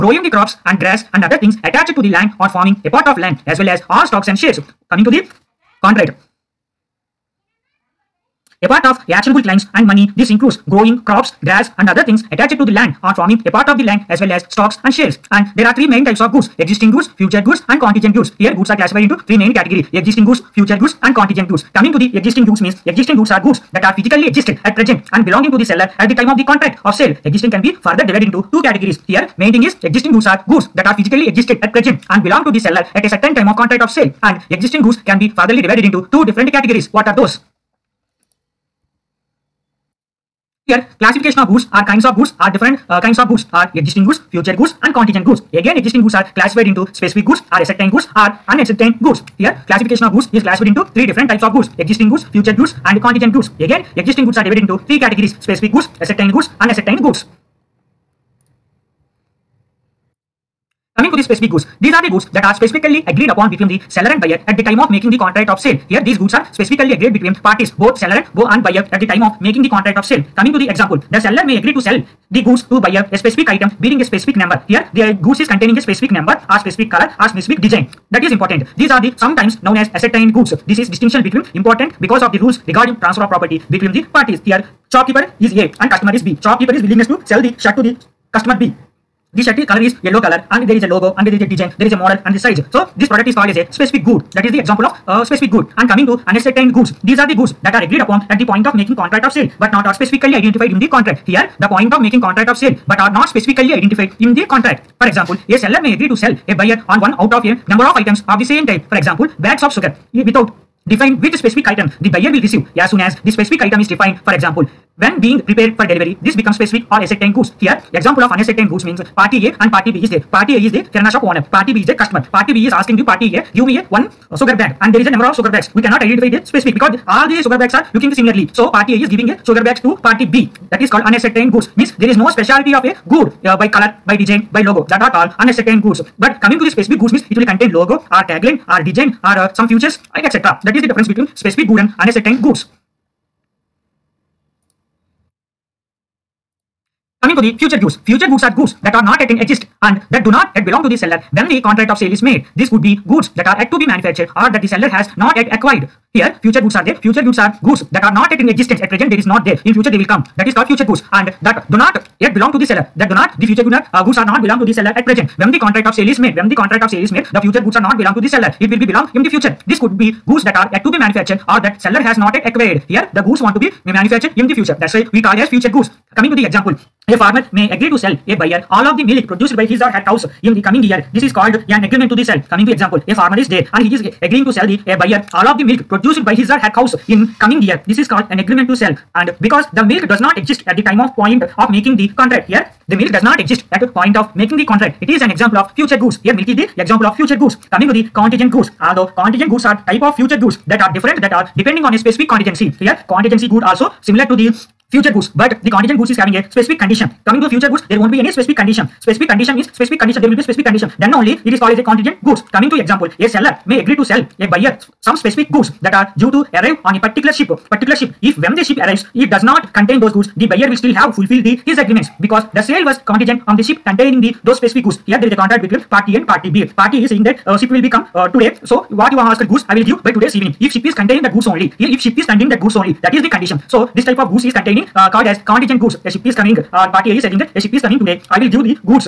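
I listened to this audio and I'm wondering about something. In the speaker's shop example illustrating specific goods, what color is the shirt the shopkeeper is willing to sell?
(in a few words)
yellow.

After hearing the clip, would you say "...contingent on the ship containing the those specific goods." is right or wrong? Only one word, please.
right.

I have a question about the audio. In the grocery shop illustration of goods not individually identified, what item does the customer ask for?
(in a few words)
sugar bag.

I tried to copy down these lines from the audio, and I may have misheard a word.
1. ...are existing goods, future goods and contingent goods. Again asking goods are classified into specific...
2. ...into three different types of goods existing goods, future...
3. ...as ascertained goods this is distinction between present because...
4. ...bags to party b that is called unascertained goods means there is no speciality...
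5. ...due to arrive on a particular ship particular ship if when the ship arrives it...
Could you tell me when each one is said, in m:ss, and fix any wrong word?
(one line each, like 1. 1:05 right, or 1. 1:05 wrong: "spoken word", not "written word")
1. 0:43 wrong: "existing", not "asking"
2. 0:50 right
3. 1:19 wrong: "important", not "present"
4. 2:09 right
5. 3:36 right.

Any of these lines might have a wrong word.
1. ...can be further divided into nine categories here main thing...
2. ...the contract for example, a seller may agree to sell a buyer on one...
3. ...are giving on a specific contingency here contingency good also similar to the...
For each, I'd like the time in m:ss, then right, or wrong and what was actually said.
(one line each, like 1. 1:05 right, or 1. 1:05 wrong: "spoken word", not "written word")
1. 0:27 wrong: "two", not "nine"
2. 1:44 right
3. 3:21 wrong: "depending", not "giving".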